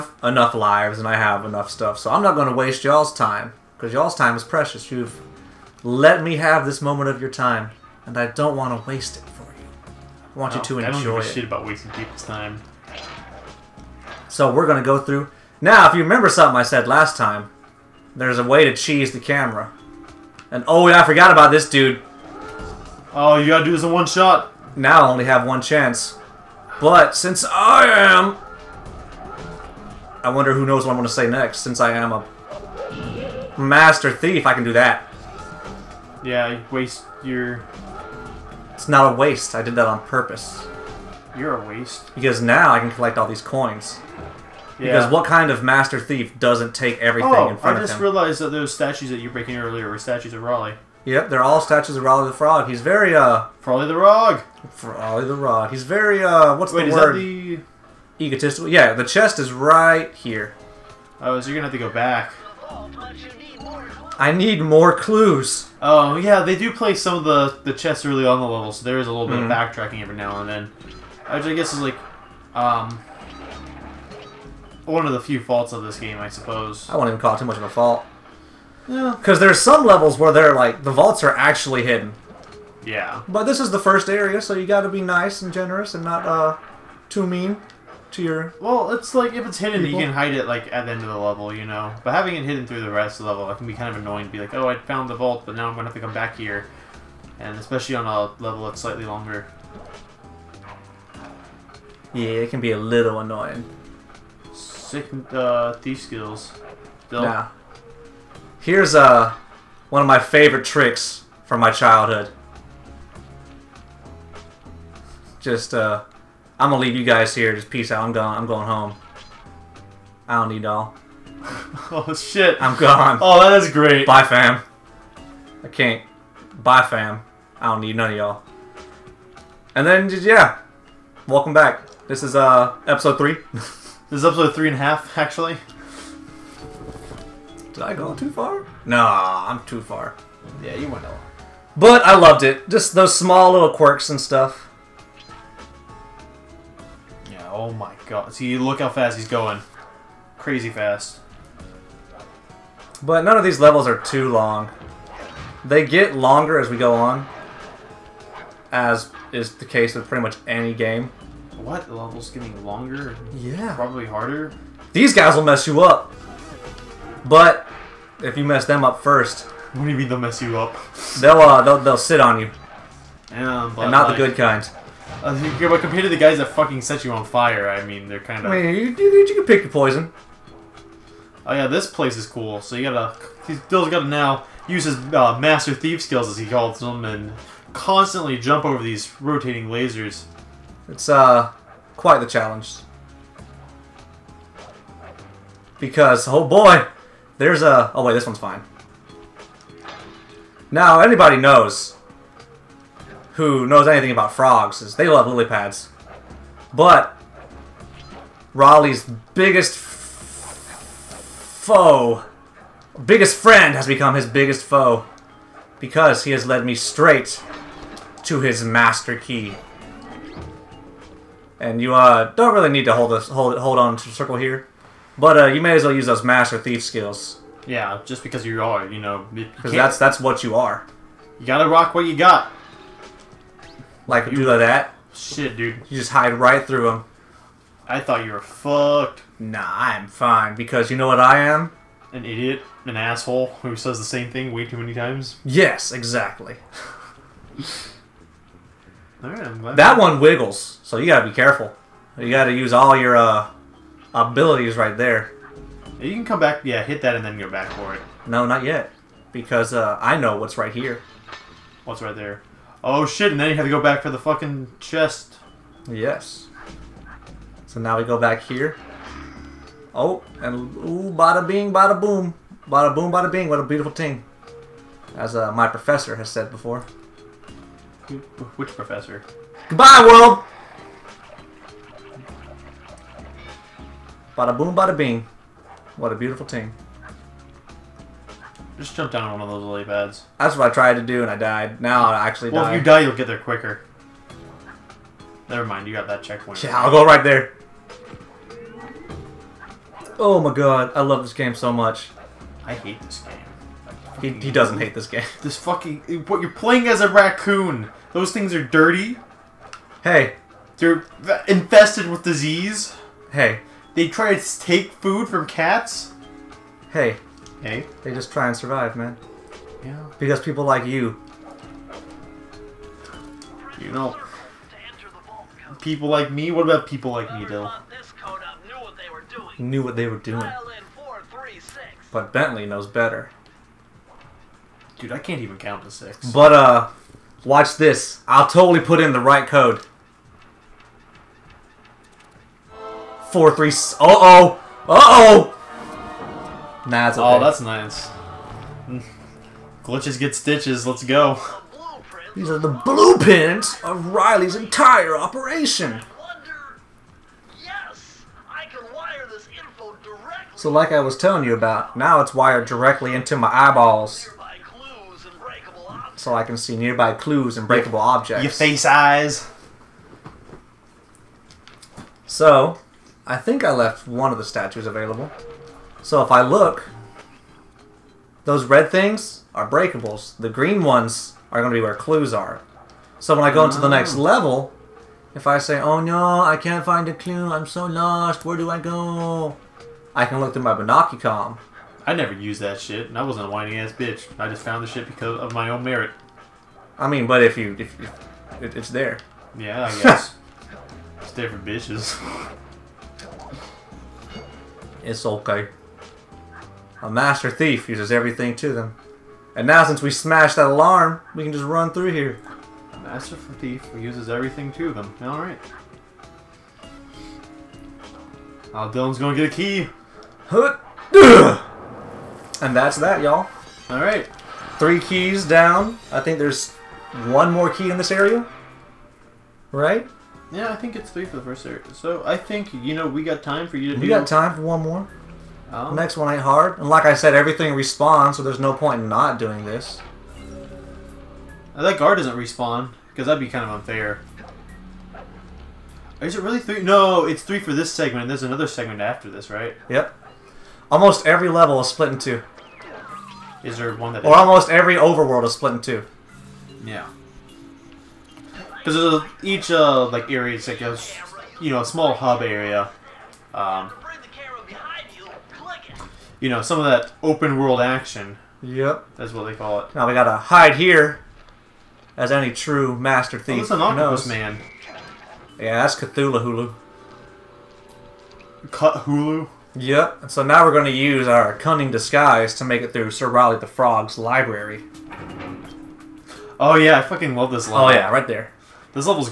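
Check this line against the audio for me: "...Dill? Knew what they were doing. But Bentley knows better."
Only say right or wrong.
right.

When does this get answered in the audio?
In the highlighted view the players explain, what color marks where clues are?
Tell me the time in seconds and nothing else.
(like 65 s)
380 s.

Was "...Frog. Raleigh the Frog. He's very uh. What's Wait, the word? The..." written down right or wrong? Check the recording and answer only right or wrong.
right.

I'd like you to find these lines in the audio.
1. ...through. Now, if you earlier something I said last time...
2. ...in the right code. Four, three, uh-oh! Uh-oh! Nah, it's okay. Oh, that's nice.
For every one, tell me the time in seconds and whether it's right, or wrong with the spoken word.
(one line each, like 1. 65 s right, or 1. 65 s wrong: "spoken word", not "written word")
1. 14 s wrong: "remember", not "earlier"
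2. 338 s right.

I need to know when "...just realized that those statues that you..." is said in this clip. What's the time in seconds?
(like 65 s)
47 s.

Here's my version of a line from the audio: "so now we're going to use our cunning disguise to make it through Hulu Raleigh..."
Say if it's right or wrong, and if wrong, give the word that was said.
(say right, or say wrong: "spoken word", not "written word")
wrong: "Sir", not "Hulu".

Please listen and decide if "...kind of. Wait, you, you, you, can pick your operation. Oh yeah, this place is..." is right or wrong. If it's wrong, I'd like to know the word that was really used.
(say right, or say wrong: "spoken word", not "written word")
wrong: "poison", not "operation".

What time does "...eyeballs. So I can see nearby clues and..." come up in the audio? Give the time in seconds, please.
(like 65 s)
363 s.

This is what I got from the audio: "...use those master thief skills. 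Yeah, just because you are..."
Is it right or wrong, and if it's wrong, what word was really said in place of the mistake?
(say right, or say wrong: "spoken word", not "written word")
right.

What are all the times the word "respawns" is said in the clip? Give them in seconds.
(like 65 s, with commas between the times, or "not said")
437 s, 442 s.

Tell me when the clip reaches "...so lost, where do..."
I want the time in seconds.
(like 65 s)
387 s.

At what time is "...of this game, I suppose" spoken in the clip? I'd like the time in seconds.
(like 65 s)
75 s.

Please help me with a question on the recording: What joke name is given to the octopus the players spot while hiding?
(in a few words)
Cthulhu Hulu.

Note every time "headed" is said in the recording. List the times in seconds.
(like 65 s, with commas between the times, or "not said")
not said.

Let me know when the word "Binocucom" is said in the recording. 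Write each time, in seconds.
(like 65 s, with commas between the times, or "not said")
390 s.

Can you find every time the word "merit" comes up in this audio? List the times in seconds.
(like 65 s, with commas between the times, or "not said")
395 s.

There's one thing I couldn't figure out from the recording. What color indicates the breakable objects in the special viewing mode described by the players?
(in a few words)
Red.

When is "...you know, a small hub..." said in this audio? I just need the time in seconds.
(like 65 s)
461 s.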